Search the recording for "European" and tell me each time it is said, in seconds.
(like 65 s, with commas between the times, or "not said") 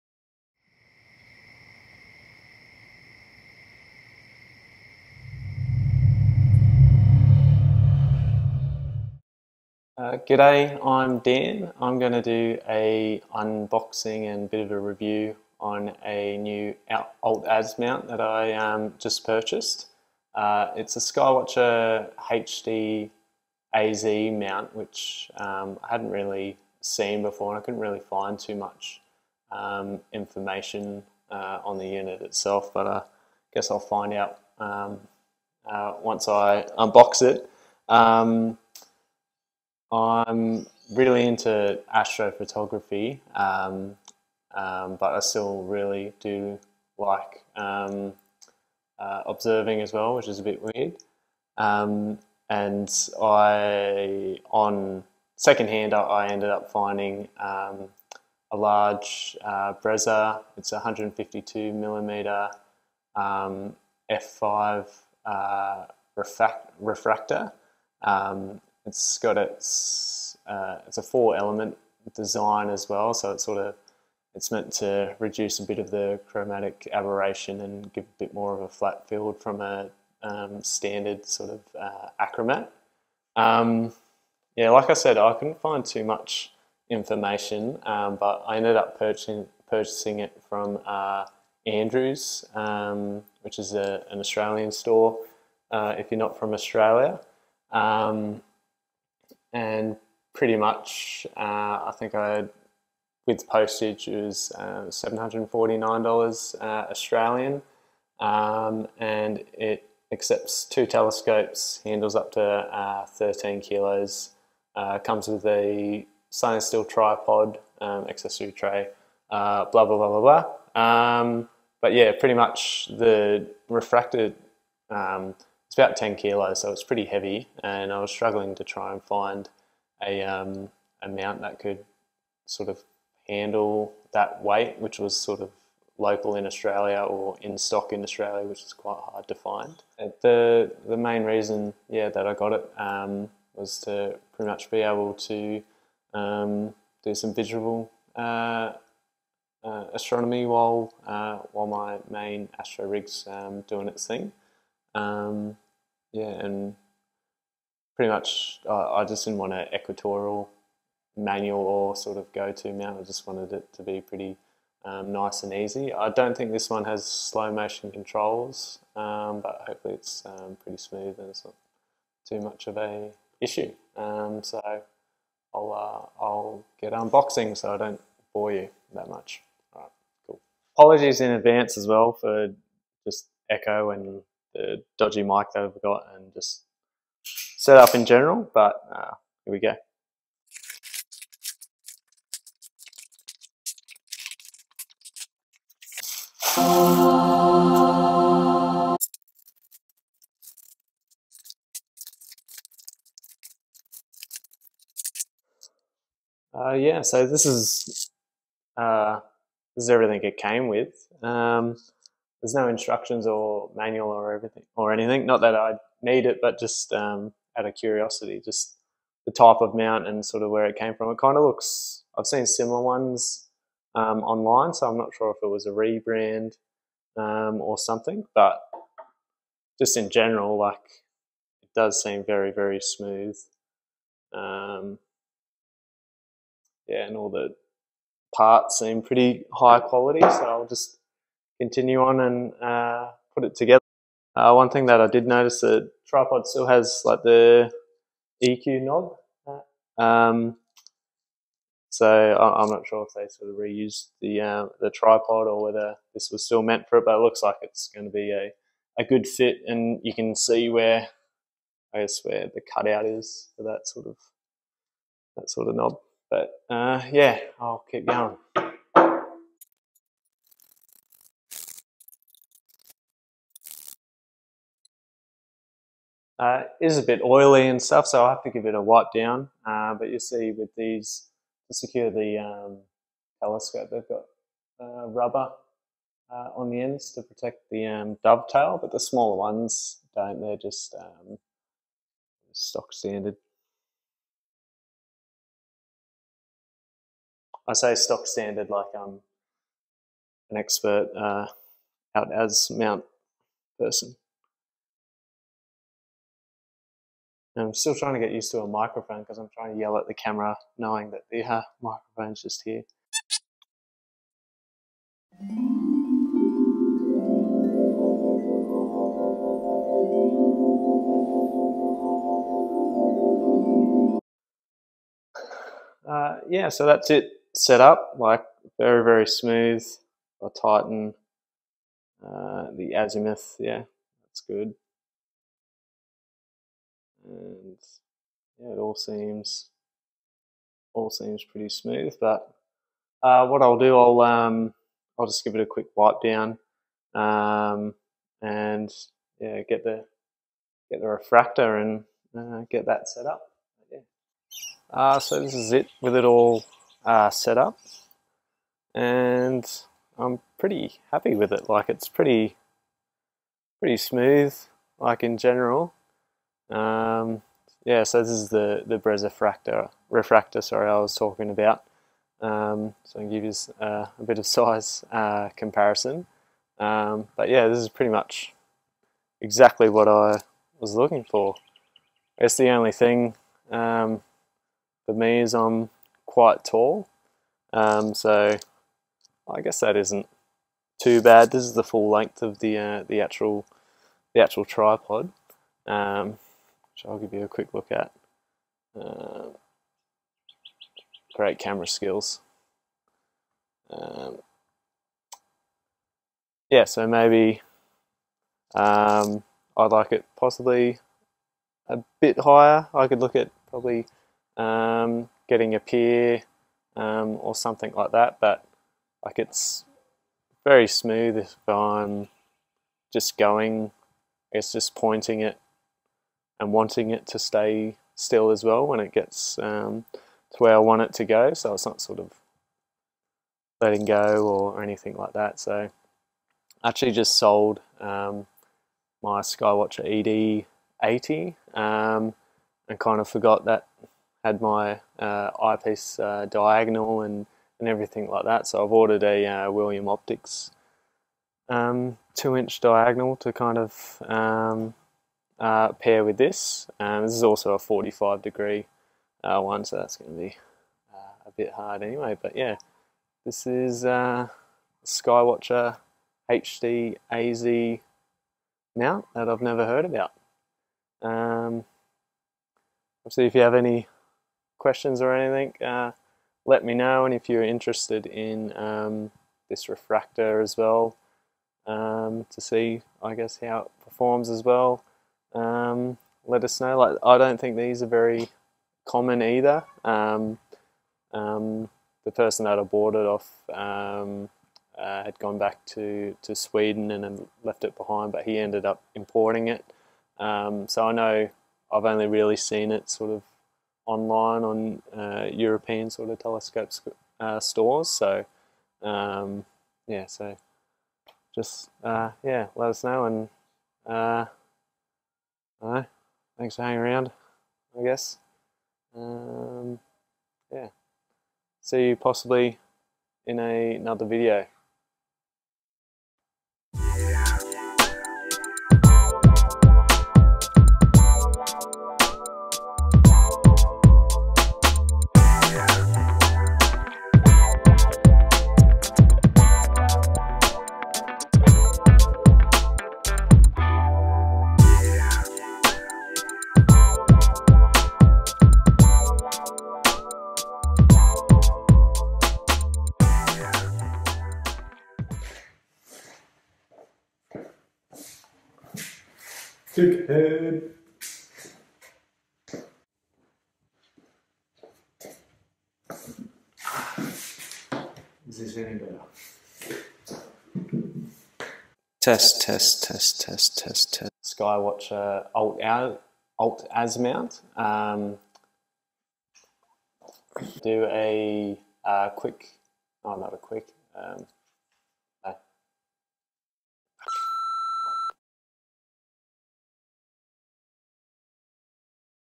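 505 s.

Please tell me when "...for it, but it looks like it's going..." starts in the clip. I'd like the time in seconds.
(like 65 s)
256 s.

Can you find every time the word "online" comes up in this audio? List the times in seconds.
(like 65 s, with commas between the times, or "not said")
224 s, 504 s.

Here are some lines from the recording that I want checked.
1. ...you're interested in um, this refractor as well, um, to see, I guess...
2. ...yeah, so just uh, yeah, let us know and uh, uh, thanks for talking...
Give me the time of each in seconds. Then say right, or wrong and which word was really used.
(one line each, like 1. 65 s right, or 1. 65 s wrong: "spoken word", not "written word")
1. 477 s right
2. 510 s wrong: "hanging", not "talking".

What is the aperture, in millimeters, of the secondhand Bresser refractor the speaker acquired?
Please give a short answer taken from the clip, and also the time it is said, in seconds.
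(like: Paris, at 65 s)
152, at 60 s.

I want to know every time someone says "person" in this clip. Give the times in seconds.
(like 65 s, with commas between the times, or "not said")
303 s, 492 s.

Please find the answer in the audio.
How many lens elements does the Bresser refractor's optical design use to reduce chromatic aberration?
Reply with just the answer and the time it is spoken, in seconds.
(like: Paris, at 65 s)
four, at 71 s.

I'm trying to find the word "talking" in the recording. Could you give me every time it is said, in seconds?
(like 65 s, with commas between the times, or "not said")
371 s.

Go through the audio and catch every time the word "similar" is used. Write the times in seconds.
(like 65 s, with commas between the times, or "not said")
222 s.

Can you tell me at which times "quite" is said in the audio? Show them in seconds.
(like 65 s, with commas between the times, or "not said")
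138 s, 386 s.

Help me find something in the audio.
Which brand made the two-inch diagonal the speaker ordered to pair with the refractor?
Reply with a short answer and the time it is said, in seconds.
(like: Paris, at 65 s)
William Optics, at 449 s.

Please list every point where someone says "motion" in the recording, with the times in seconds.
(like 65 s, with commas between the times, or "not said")
167 s.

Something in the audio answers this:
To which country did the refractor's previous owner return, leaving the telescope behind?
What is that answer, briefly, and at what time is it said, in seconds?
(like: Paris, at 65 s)
Sweden, at 496 s.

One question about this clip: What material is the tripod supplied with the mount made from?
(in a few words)
stainless steel.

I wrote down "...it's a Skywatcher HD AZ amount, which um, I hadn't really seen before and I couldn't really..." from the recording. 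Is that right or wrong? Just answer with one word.
wrong.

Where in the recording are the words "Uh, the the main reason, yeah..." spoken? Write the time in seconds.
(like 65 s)
139 s.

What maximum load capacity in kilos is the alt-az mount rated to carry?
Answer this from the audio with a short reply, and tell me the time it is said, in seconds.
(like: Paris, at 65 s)
13 kilos, at 113 s.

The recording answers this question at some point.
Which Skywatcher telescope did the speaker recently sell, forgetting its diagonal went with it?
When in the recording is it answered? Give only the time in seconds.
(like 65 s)
439 s.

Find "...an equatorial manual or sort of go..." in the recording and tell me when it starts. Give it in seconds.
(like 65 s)
159 s.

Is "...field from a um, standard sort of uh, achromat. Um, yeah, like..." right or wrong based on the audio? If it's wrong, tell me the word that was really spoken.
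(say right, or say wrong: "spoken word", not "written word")
right.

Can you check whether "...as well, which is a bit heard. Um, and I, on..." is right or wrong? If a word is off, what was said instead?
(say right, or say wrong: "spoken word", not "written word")
wrong: "weird", not "heard".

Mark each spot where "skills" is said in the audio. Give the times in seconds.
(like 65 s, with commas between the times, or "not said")
401 s.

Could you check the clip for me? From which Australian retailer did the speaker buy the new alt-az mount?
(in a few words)
Andrews.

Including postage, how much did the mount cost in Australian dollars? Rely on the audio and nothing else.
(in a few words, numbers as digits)
$749.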